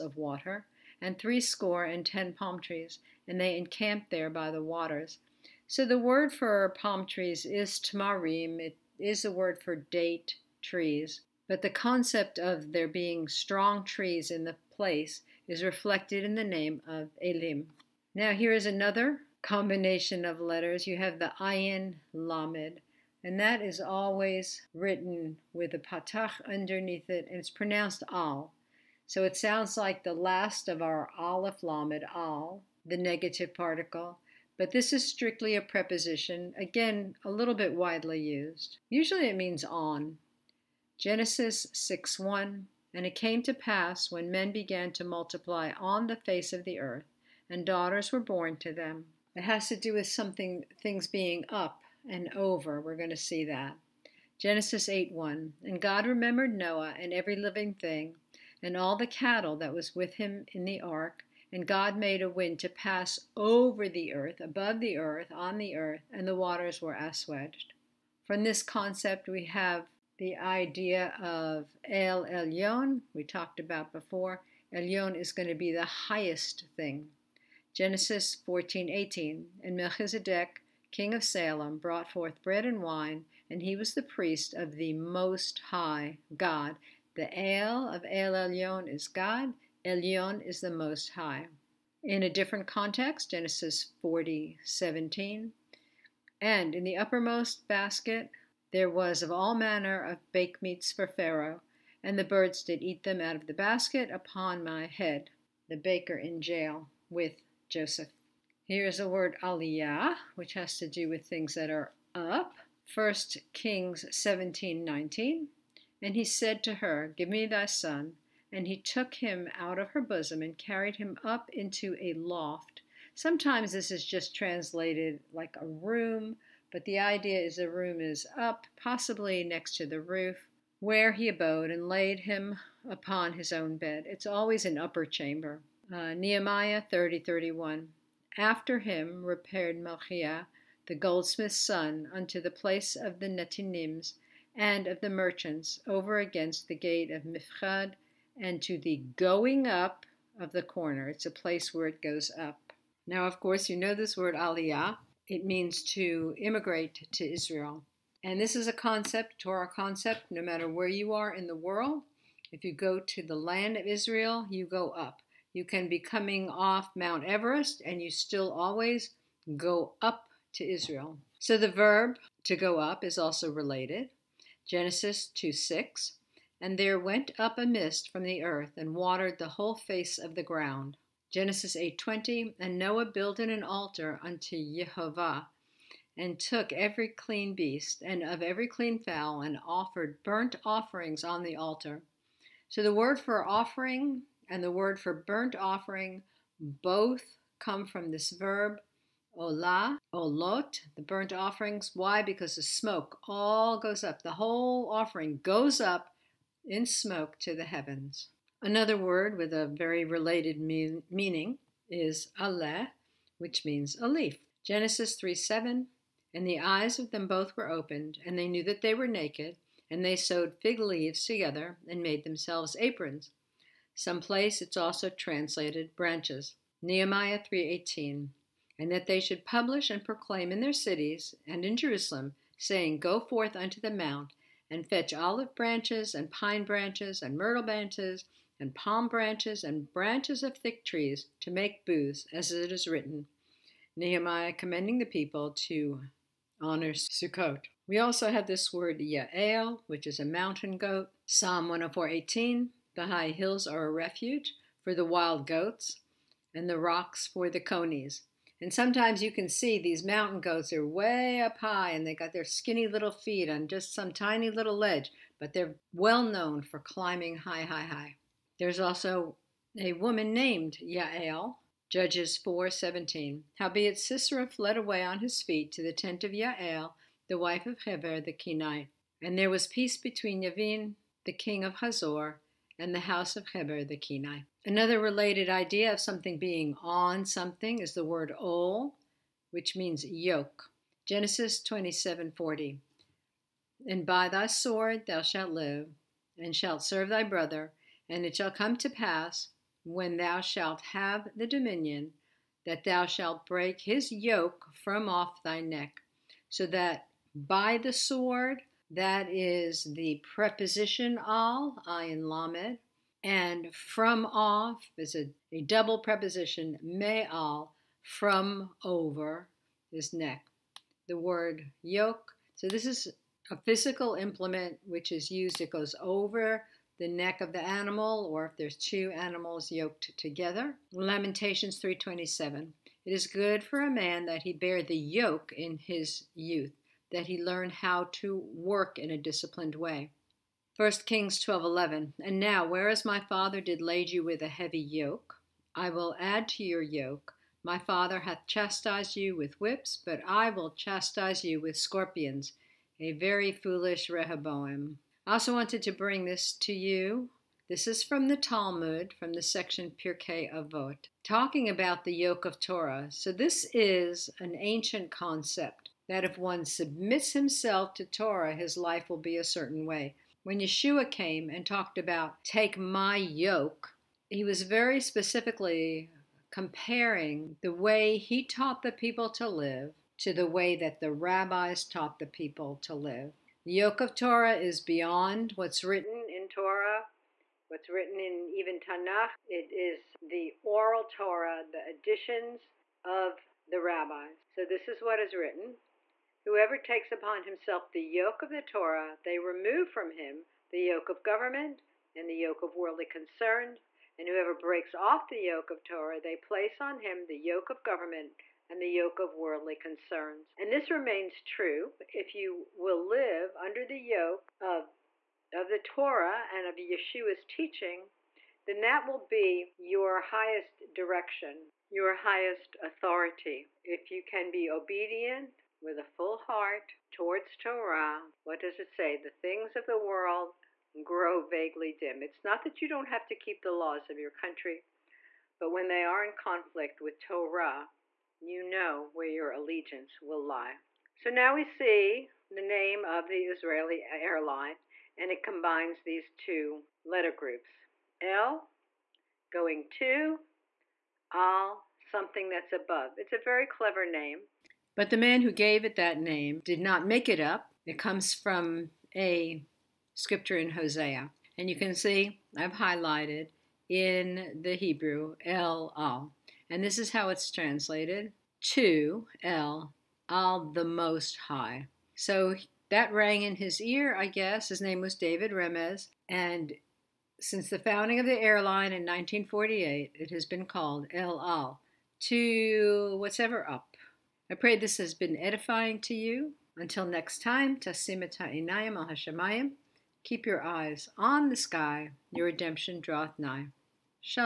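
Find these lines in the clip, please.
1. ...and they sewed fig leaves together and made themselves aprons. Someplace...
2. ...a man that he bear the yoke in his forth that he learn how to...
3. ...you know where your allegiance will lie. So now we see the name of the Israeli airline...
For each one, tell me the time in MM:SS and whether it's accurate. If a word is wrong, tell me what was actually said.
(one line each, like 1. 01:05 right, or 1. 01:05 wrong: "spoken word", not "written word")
1. 03:39 right
2. 05:33 wrong: "youth", not "forth"
3. 07:18 right.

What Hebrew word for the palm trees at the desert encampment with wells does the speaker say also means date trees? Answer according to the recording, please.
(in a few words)
tamarim.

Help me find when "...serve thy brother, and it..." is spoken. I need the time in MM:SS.
04:56.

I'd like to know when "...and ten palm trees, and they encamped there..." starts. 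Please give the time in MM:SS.
00:01.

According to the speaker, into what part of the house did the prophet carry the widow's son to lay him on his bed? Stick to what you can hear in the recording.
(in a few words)
a loft.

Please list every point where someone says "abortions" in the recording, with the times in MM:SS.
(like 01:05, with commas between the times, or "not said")
not said.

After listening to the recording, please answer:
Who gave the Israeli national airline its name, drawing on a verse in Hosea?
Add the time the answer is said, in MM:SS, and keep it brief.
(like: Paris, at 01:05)
David Remez, at 07:55.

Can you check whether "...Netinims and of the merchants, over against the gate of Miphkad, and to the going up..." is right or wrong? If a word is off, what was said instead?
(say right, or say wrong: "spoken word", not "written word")
right.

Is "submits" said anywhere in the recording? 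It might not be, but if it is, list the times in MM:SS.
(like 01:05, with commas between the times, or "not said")
06:06.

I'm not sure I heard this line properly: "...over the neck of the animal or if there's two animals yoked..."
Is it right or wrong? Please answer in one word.
right.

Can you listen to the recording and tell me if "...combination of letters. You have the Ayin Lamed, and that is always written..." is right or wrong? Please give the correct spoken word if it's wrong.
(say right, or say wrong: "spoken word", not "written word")
right.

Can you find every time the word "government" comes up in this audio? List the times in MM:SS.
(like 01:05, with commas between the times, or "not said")
06:41, 06:47.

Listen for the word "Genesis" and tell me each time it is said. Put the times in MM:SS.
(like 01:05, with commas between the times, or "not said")
00:40, 00:54, 01:17, 01:33, 02:54, 03:01, 03:34, 04:51.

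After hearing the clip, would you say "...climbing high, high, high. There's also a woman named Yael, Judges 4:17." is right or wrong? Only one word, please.
right.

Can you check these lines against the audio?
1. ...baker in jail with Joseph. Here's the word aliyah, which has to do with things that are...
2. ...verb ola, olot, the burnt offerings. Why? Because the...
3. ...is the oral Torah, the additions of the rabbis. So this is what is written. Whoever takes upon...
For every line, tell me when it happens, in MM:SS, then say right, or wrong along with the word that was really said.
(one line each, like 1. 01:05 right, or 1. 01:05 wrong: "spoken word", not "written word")
1. 01:45 right
2. 03:18 right
3. 06:29 right.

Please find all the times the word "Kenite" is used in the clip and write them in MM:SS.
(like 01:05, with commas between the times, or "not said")
04:38, 04:43.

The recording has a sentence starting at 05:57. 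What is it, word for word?
This is from the Talmud, from the section Pirkei Avot, talking about the yoke of Torah.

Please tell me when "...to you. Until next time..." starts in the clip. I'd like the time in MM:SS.
08:06.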